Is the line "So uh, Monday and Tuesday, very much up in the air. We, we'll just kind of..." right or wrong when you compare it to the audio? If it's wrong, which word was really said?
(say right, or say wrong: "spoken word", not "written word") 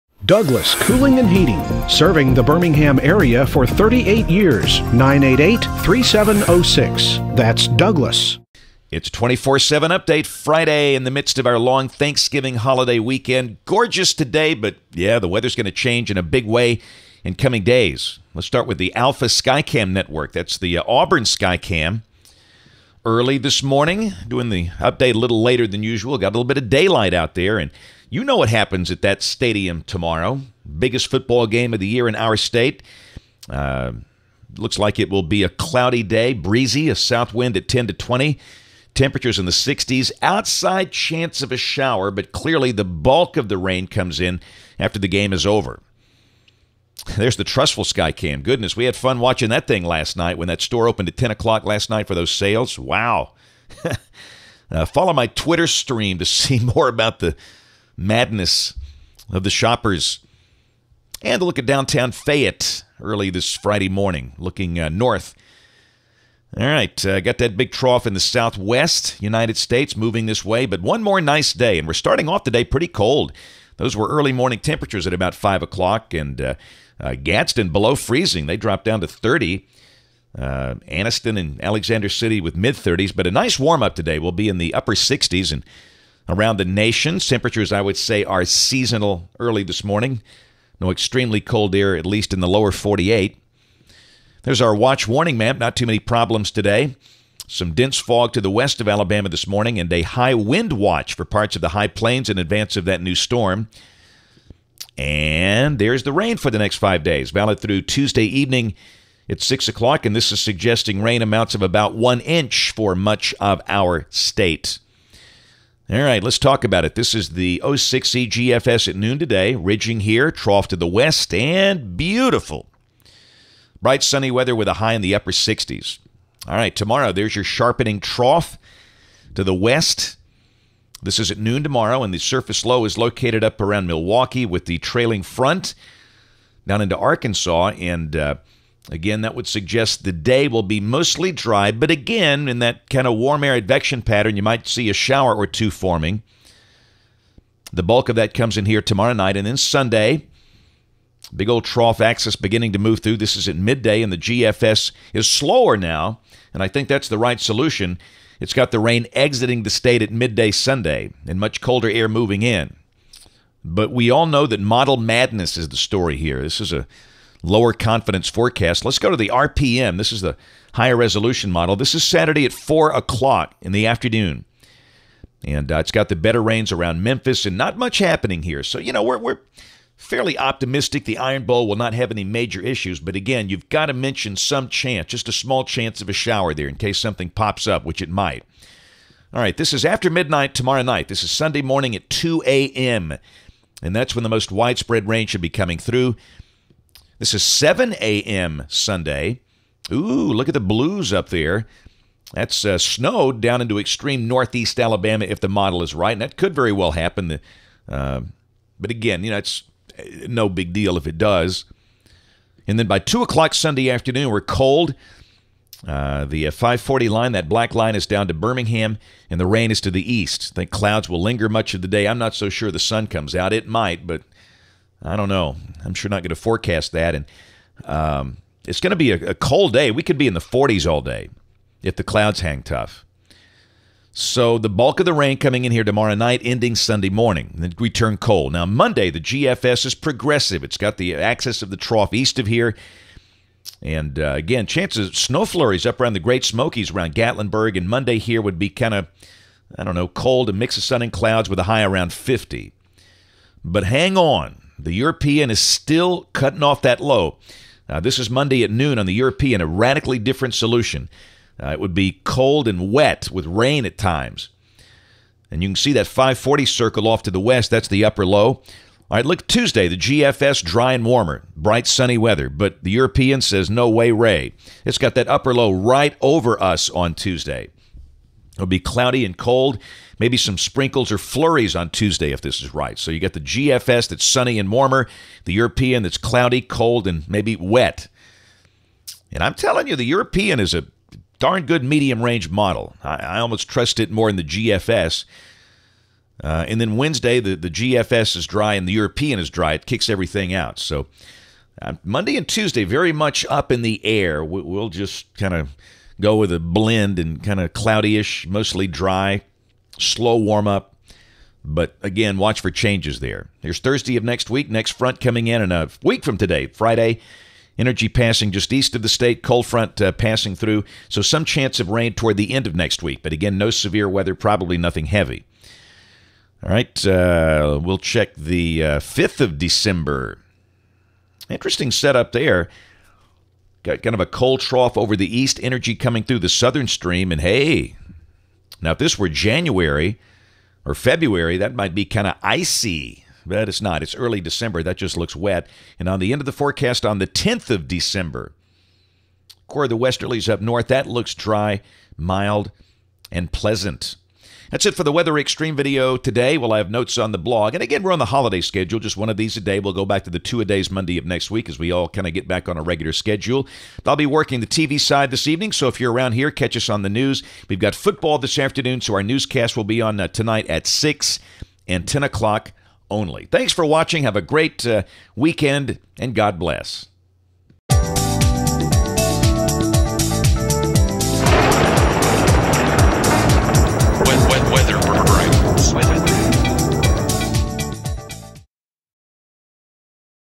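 right.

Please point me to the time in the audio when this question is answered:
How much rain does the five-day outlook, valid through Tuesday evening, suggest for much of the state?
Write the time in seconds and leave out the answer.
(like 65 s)
111 s.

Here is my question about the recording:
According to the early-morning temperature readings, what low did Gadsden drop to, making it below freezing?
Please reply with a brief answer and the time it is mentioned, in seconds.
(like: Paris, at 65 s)
30, at 78 s.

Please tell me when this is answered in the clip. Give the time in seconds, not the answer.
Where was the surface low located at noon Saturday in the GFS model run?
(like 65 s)
133 s.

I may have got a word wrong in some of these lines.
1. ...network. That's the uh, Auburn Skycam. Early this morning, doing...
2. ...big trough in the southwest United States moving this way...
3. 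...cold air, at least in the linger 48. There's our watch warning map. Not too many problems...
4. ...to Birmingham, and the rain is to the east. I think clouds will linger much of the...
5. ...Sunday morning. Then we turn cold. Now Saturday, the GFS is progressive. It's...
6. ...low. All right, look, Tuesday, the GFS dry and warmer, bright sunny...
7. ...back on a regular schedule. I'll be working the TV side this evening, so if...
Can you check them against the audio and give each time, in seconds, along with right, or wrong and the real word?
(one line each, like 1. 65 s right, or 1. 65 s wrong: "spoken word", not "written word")
1. 19 s right
2. 67 s right
3. 91 s wrong: "lower", not "linger"
4. 218 s right
5. 236 s wrong: "Monday", not "Saturday"
6. 268 s right
7. 362 s right.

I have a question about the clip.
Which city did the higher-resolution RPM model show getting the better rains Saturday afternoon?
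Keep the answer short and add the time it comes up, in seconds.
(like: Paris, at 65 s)
Memphis, at 177 s.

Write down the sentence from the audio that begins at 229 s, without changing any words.
We could be in the 40s all day if the clouds hang tough.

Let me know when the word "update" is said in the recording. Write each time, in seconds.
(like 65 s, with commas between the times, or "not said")
9 s, 24 s.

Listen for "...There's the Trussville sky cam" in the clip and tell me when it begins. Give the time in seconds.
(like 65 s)
47 s.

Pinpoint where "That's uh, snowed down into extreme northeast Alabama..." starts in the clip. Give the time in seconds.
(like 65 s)
202 s.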